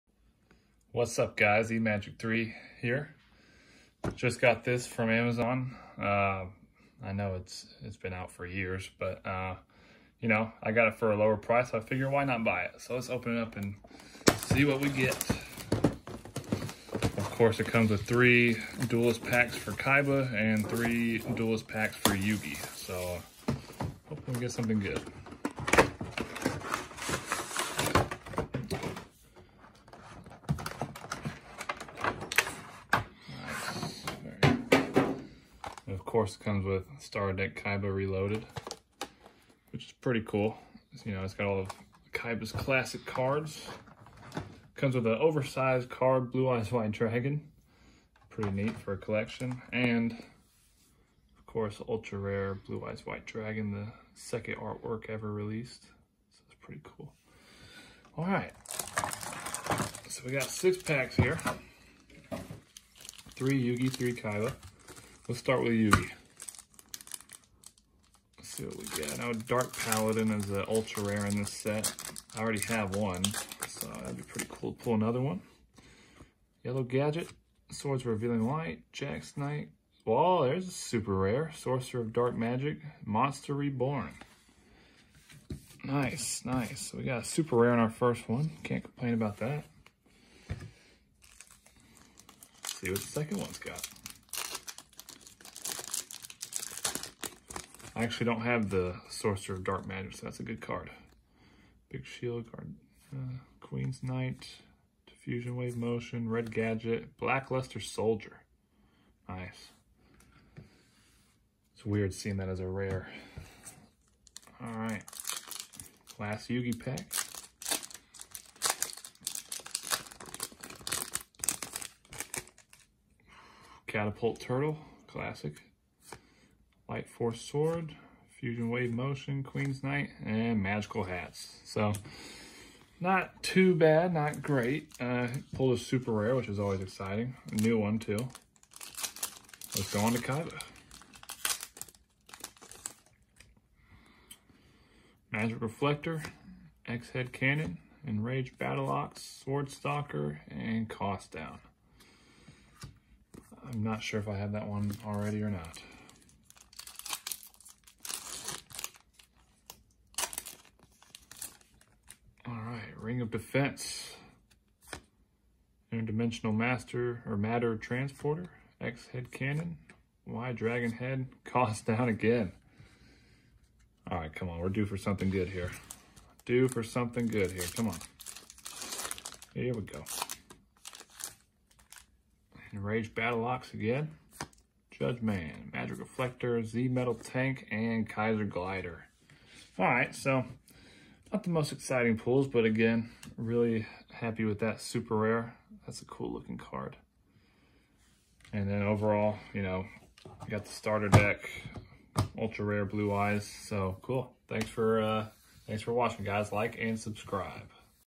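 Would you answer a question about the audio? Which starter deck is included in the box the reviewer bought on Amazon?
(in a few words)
Kaiba Reloaded.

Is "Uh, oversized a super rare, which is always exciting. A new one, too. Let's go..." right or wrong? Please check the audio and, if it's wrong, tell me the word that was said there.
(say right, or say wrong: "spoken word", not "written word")
wrong: "pulled", not "oversized".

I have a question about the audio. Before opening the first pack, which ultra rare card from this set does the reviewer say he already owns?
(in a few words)
Dark Paladin.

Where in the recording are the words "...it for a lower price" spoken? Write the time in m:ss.
0:10.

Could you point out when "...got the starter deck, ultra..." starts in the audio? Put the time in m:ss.
3:20.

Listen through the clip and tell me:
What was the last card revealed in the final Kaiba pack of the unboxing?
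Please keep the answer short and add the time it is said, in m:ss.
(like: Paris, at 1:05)
Kaiser Glider, at 3:08.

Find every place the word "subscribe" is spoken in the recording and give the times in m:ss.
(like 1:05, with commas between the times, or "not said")
3:26.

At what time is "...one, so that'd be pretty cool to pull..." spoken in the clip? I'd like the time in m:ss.
1:12.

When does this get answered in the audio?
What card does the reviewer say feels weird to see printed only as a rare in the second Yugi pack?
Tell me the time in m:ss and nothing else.
1:47.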